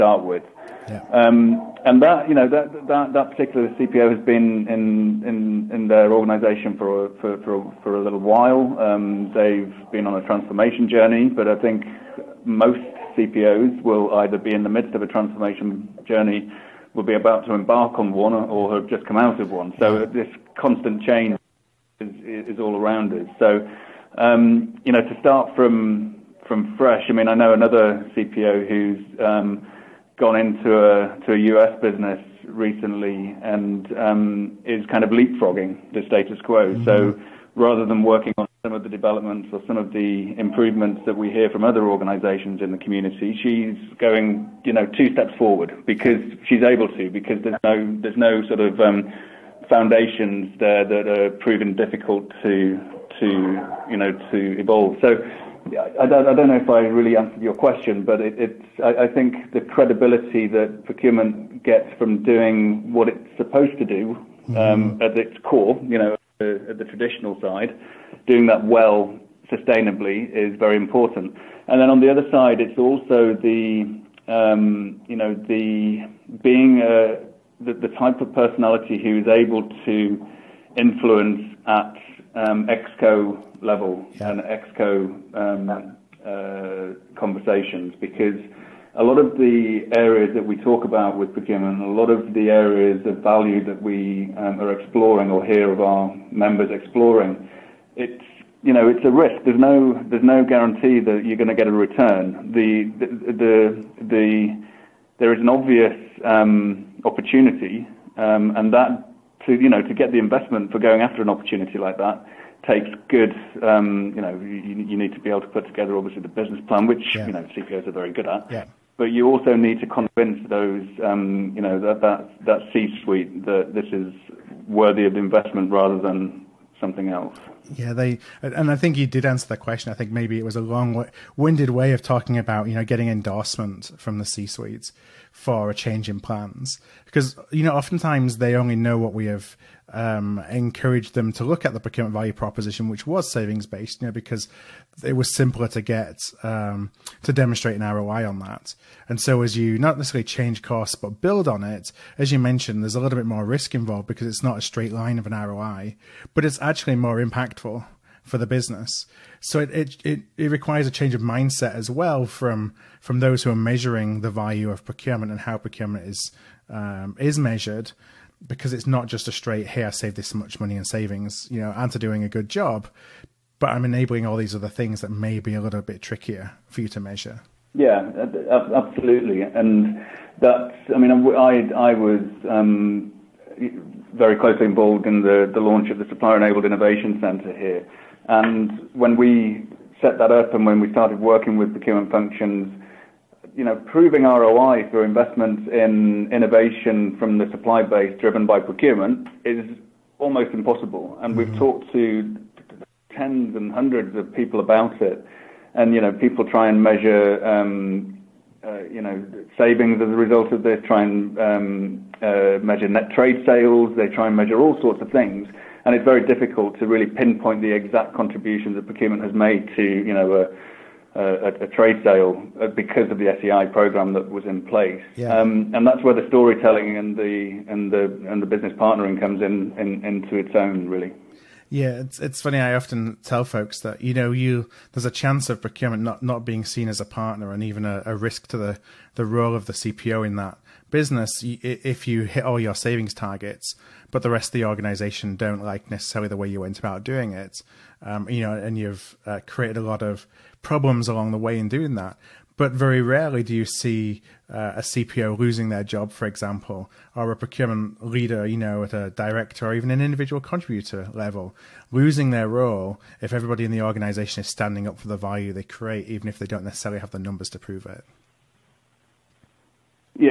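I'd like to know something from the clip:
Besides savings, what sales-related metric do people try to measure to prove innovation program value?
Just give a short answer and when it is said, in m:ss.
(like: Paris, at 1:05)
net trade sales, at 3:32.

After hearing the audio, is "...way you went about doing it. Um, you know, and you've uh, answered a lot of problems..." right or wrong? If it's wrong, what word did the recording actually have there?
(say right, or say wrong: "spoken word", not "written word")
wrong: "created", not "answered".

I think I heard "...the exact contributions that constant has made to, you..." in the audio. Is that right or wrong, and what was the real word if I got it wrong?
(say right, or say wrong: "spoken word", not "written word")
wrong: "procurement", not "constant".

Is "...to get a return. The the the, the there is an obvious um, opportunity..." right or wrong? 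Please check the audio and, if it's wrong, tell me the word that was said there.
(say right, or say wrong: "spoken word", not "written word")
right.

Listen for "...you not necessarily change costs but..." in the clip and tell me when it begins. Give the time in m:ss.
2:29.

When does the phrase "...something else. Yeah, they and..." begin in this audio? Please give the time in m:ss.
2:06.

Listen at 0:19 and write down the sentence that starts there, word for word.
So this constant change is, is all around us.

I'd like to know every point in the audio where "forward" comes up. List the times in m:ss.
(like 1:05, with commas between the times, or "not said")
0:45.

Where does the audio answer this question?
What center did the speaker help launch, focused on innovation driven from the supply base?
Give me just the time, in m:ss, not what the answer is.
3:06.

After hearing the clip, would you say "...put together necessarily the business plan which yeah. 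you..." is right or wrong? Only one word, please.
wrong.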